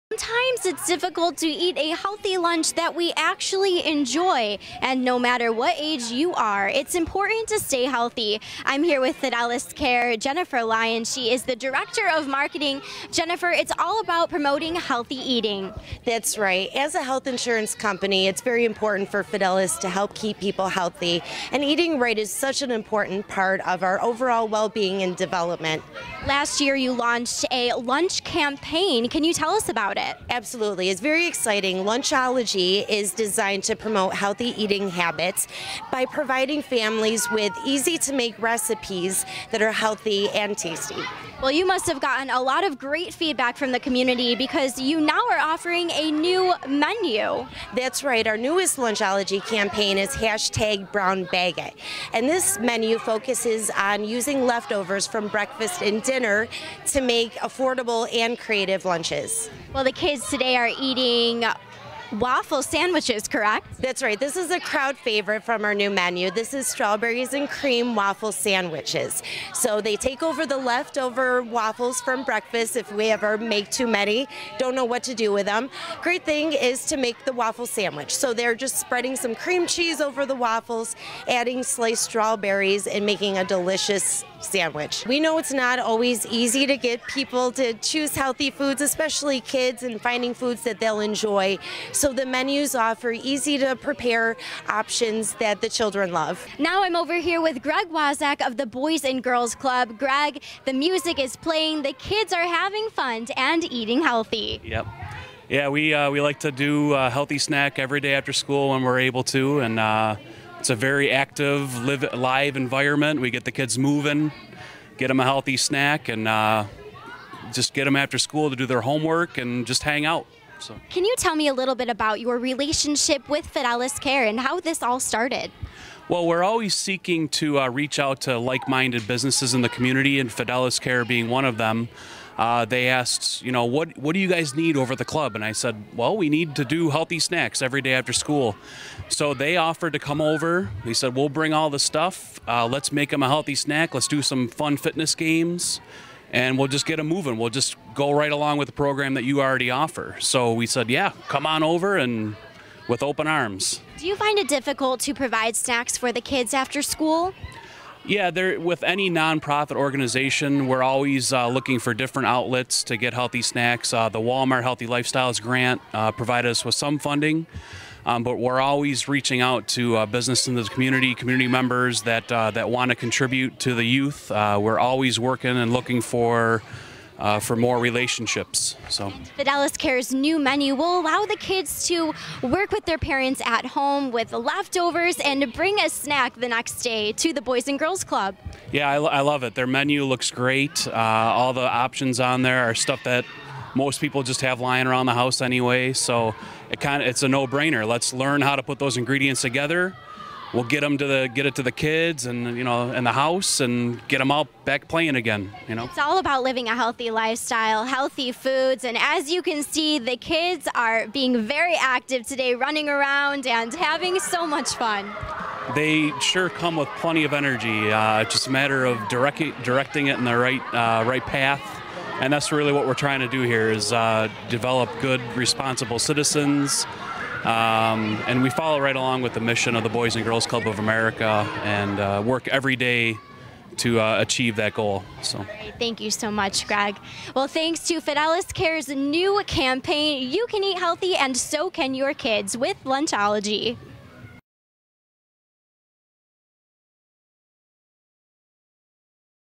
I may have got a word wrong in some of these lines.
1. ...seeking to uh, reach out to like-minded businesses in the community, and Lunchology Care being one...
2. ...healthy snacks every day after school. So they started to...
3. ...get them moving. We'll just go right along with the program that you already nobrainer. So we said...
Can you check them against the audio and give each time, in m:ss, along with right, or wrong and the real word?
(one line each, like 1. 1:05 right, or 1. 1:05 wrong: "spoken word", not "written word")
1. 2:06 wrong: "Fidelis", not "Lunchology"
2. 2:16 wrong: "offered", not "started"
3. 2:26 wrong: "offer", not "nobrainer".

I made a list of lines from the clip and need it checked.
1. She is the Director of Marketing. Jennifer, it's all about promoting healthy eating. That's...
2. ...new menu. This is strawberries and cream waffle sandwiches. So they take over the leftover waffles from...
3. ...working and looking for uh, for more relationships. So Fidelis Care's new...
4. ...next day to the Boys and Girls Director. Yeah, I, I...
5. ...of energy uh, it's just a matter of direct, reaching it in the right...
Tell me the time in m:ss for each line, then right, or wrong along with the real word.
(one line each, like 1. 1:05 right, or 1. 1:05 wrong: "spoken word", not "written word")
1. 0:11 right
2. 1:05 right
3. 2:55 right
4. 3:06 wrong: "Club", not "Director"
5. 3:37 wrong: "directing", not "reaching".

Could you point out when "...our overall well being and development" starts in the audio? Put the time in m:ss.
0:23.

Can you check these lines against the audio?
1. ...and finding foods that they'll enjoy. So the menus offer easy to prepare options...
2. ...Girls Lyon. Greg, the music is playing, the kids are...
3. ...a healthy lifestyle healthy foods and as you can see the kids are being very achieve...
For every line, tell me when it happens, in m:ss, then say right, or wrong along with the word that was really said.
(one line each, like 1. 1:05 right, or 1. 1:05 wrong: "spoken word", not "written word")
1. 1:29 right
2. 1:39 wrong: "Club", not "Lyon"
3. 3:26 wrong: "active", not "achieve".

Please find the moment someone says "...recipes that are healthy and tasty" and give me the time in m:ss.
0:38.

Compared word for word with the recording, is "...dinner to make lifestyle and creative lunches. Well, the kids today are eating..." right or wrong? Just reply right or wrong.
wrong.